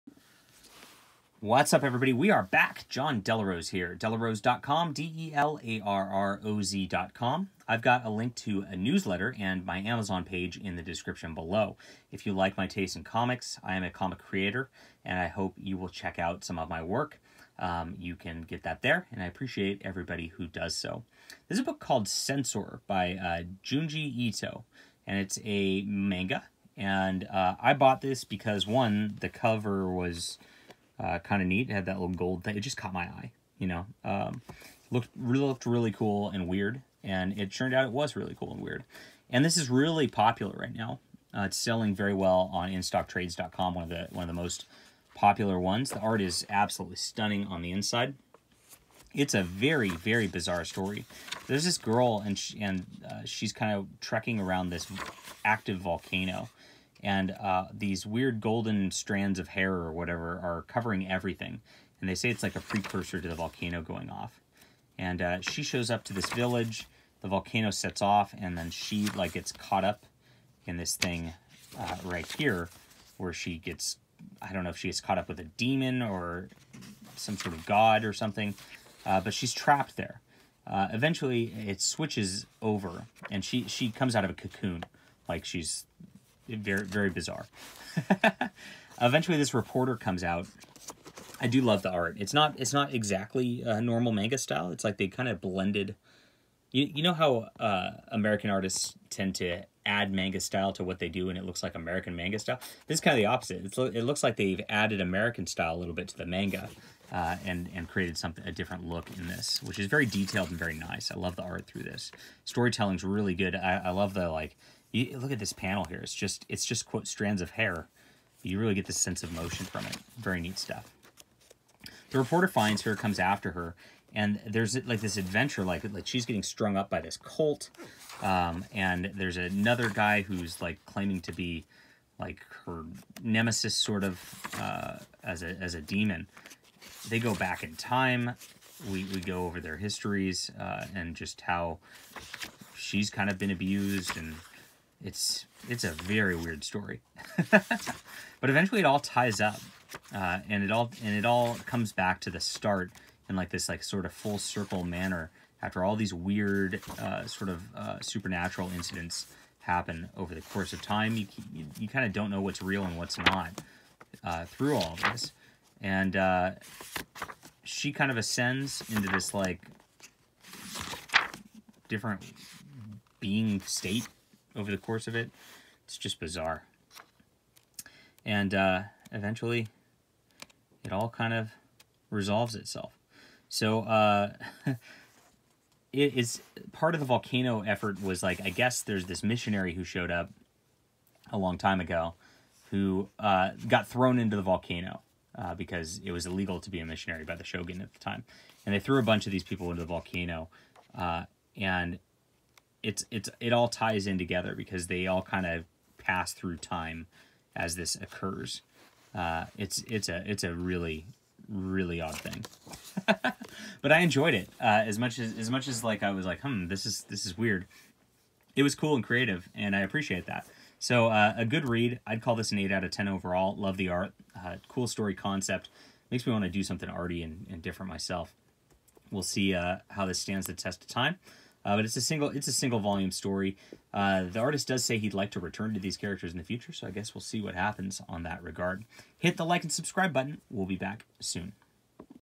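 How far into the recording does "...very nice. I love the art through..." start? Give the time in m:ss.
1:50.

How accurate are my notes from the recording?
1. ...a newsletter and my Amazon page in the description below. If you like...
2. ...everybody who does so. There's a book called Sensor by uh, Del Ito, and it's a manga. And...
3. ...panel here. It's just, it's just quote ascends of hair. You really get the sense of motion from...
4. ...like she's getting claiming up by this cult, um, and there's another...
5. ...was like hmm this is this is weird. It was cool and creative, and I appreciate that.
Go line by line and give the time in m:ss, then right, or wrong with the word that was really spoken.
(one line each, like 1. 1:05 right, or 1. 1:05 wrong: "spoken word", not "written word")
1. 0:08 right
2. 0:19 wrong: "Junji", not "Del"
3. 1:55 wrong: "strands", not "ascends"
4. 2:05 wrong: "strung", not "claiming"
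5. 3:36 right.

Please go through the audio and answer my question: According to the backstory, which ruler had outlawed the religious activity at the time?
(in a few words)
the shogun.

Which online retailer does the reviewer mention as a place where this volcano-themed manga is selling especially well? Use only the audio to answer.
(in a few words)
InStockTrades.com.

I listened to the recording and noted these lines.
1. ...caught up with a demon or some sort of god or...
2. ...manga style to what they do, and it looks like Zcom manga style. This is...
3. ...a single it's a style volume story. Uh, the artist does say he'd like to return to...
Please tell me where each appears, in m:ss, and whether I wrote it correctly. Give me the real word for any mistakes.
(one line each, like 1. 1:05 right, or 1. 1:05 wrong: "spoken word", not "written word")
1. 1:15 right
2. 1:40 wrong: "American", not "Zcom"
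3. 3:51 wrong: "single", not "style".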